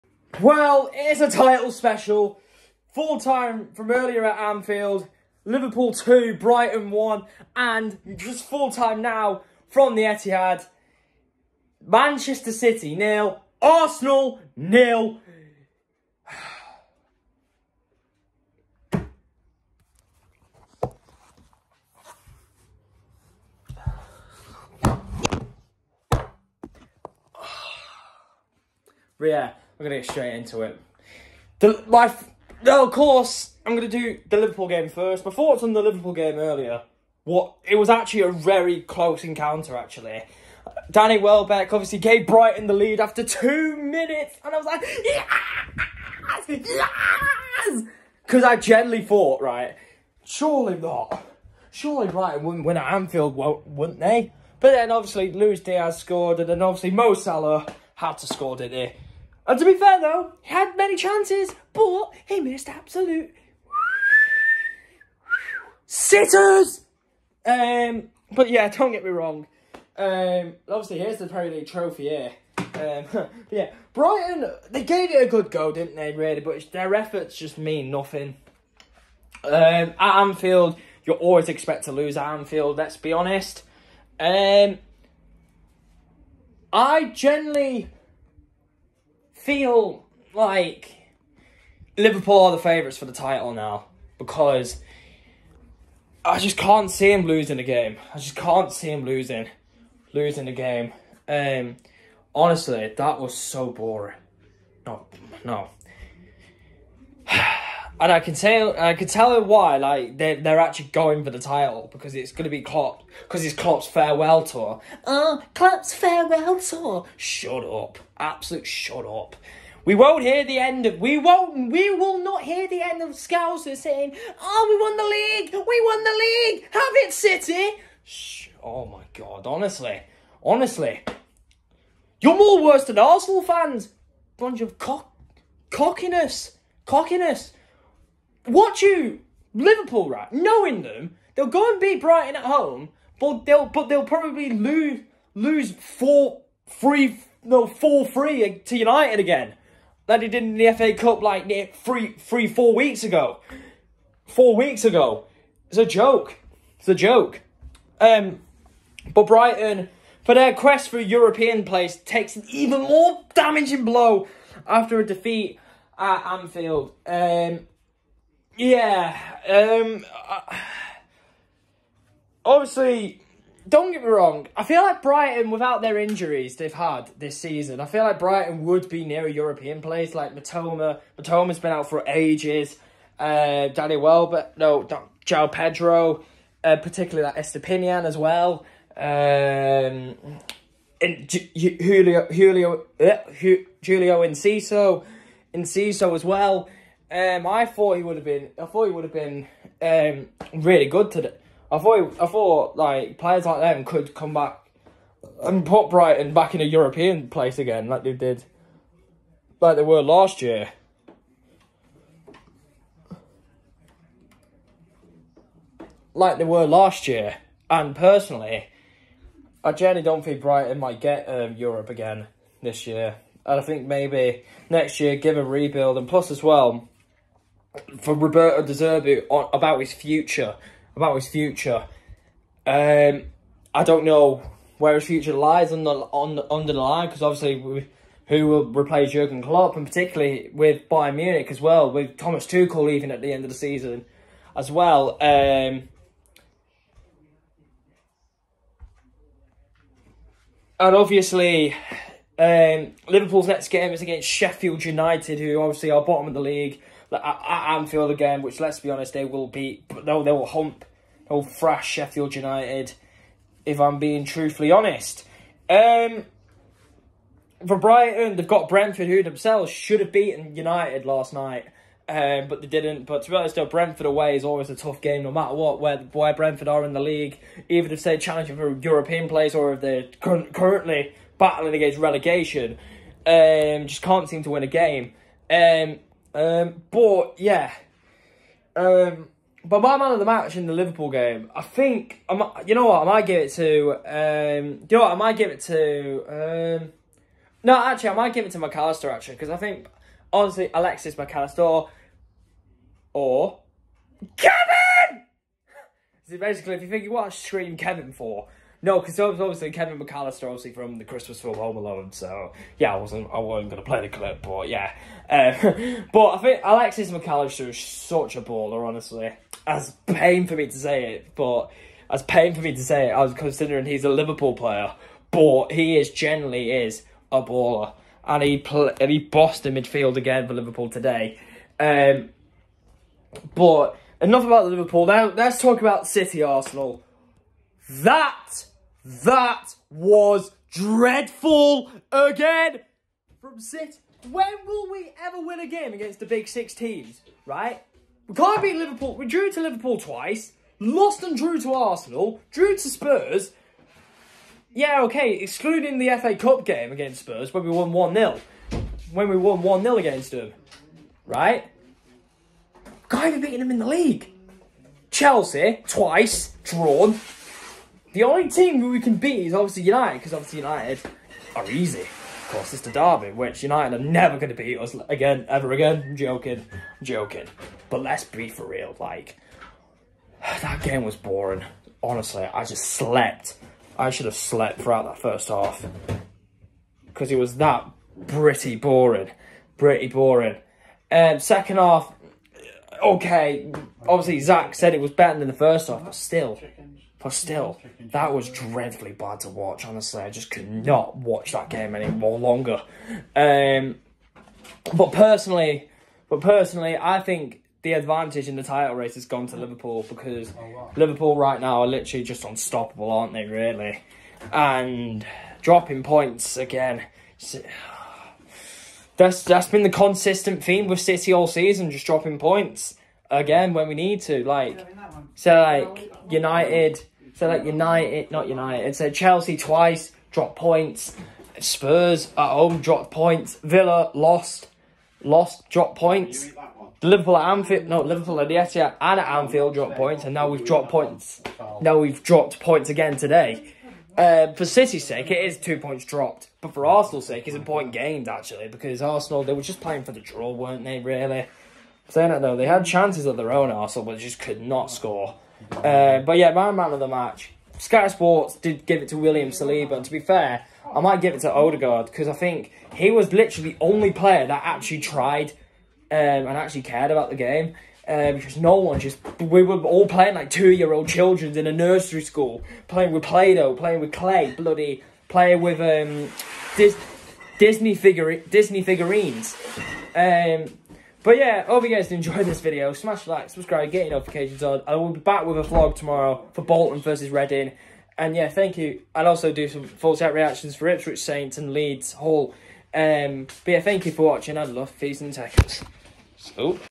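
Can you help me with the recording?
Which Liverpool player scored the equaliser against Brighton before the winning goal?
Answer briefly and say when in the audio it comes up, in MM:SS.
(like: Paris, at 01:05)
Luis Diaz, at 00:55.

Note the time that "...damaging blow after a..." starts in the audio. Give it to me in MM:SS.
02:43.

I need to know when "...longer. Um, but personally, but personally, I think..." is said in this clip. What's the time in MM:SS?
06:42.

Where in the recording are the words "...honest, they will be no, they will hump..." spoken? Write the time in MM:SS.
04:18.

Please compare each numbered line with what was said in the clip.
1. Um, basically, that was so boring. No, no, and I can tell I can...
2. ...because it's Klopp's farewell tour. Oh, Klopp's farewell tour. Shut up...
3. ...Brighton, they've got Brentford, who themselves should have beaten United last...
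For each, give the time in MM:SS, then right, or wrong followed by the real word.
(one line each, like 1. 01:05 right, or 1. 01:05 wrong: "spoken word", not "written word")
1. 01:41 wrong: "honestly", not "basically"
2. 01:53 right
3. 04:27 right.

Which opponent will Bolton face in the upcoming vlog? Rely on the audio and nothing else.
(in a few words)
Reading.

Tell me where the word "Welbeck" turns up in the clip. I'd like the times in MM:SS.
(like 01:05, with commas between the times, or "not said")
00:41, 03:03.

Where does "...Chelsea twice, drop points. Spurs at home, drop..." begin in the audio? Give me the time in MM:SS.
07:09.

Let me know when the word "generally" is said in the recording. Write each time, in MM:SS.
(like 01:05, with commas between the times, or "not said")
01:27, 03:39, 05:26.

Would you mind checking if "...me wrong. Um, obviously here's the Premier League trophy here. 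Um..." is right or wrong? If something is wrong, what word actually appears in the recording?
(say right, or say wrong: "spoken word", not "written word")
right.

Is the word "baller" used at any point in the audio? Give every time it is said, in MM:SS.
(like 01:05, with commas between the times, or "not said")
05:18, 05:27.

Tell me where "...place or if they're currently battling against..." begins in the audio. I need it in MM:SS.
04:39.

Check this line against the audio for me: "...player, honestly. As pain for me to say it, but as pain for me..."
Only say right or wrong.
wrong.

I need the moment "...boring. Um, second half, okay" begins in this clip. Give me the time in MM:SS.
06:30.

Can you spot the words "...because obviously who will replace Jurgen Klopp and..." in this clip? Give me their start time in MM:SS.
03:57.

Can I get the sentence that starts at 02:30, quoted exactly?
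that they did in the FA Cup like three three four weeks ago.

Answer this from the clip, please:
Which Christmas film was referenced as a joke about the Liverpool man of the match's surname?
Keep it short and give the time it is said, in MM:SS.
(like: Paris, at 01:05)
Home Alone, at 05:11.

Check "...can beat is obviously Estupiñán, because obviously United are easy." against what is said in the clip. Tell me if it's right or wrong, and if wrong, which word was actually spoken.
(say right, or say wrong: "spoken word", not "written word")
wrong: "United", not "Estupiñán".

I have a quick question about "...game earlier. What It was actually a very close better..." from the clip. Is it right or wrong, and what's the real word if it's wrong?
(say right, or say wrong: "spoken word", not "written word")
wrong: "encounter", not "better".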